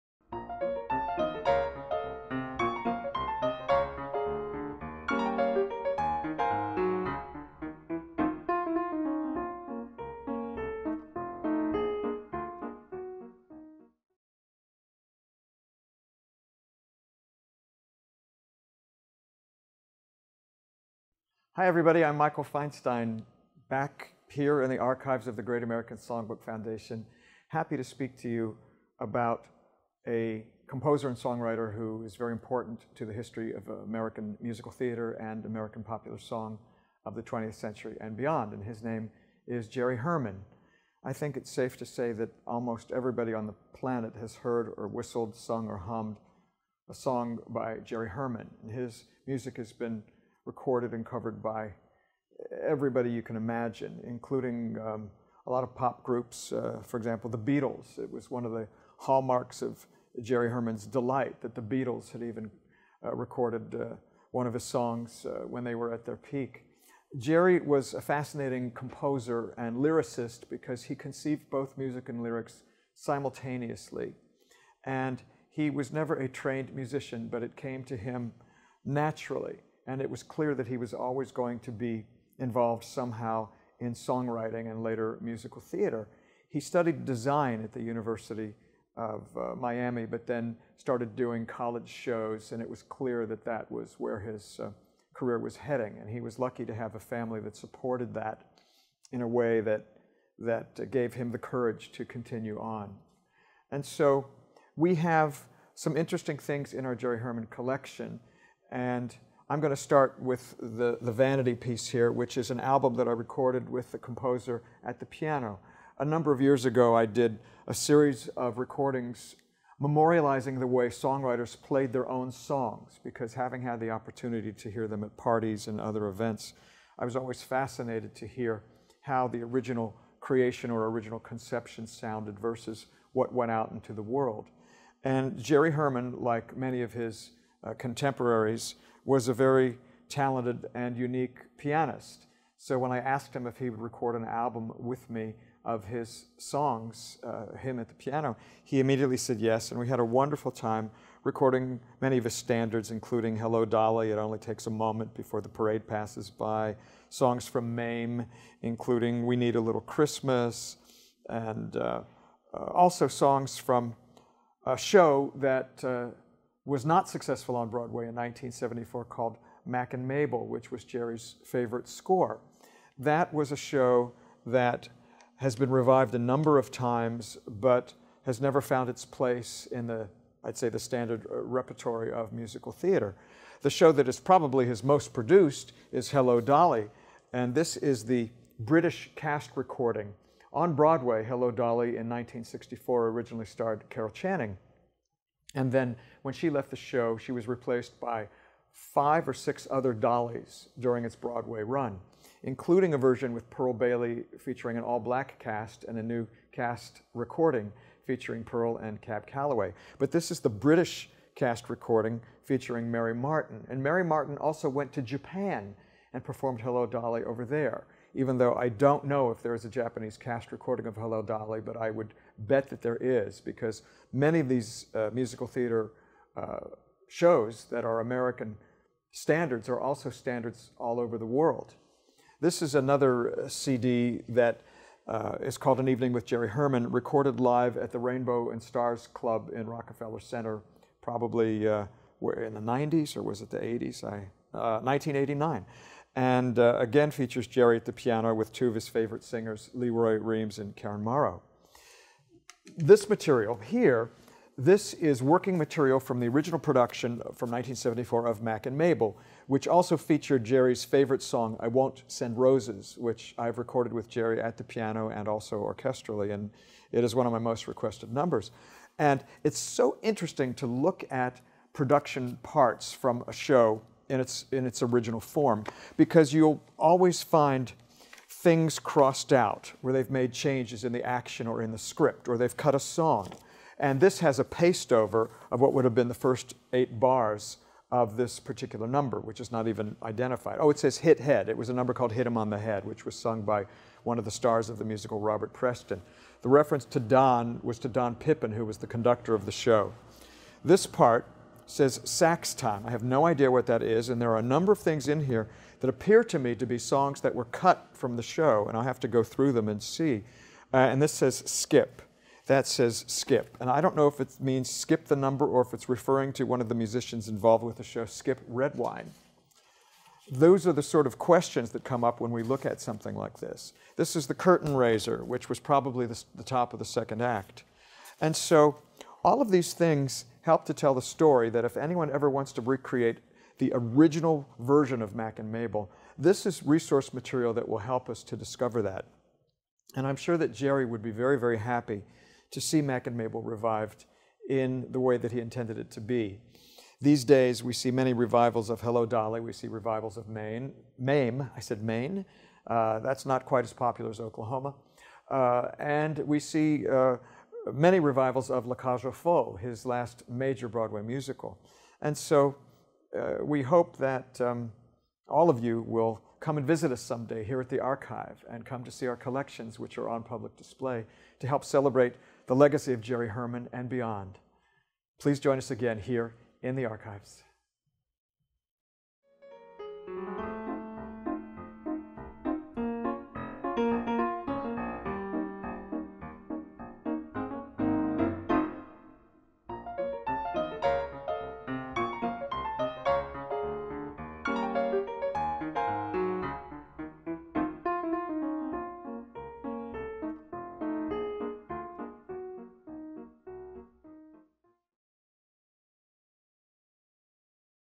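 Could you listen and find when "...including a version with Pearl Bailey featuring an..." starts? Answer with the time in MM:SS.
03:22.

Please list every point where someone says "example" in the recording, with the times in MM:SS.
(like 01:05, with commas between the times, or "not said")
00:56.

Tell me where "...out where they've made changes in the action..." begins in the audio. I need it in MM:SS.
04:39.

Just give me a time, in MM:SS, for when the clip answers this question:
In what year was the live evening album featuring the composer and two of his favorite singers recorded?
04:04.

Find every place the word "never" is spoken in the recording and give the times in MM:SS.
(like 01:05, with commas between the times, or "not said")
01:15, 02:58.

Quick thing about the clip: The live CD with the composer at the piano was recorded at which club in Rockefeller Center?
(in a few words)
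Rainbow and Stars.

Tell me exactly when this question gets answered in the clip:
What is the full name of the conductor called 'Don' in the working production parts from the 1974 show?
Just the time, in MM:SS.
04:57.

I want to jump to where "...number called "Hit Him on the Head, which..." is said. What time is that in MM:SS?
04:51.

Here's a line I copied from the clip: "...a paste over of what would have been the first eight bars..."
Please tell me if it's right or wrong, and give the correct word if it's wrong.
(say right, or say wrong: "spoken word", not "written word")
right.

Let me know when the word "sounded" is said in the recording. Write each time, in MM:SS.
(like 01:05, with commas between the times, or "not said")
02:11.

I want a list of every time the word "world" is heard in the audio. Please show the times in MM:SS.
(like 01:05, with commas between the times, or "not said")
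02:14, 03:51.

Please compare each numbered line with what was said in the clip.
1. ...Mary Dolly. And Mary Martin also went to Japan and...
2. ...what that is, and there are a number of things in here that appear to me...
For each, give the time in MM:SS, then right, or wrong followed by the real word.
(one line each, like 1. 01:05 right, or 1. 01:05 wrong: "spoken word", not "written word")
1. 03:32 wrong: "Martin", not "Dolly"
2. 05:03 right.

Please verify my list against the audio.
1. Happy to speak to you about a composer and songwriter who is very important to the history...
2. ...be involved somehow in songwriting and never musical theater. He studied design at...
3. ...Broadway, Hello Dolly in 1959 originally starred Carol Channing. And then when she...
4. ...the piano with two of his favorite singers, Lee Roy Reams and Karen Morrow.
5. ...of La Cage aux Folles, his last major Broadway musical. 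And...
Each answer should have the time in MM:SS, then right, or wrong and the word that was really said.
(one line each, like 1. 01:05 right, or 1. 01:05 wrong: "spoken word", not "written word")
1. 00:27 right
2. 01:21 wrong: "later", not "never"
3. 03:10 wrong: "1964", not "1959"
4. 04:07 right
5. 05:58 right.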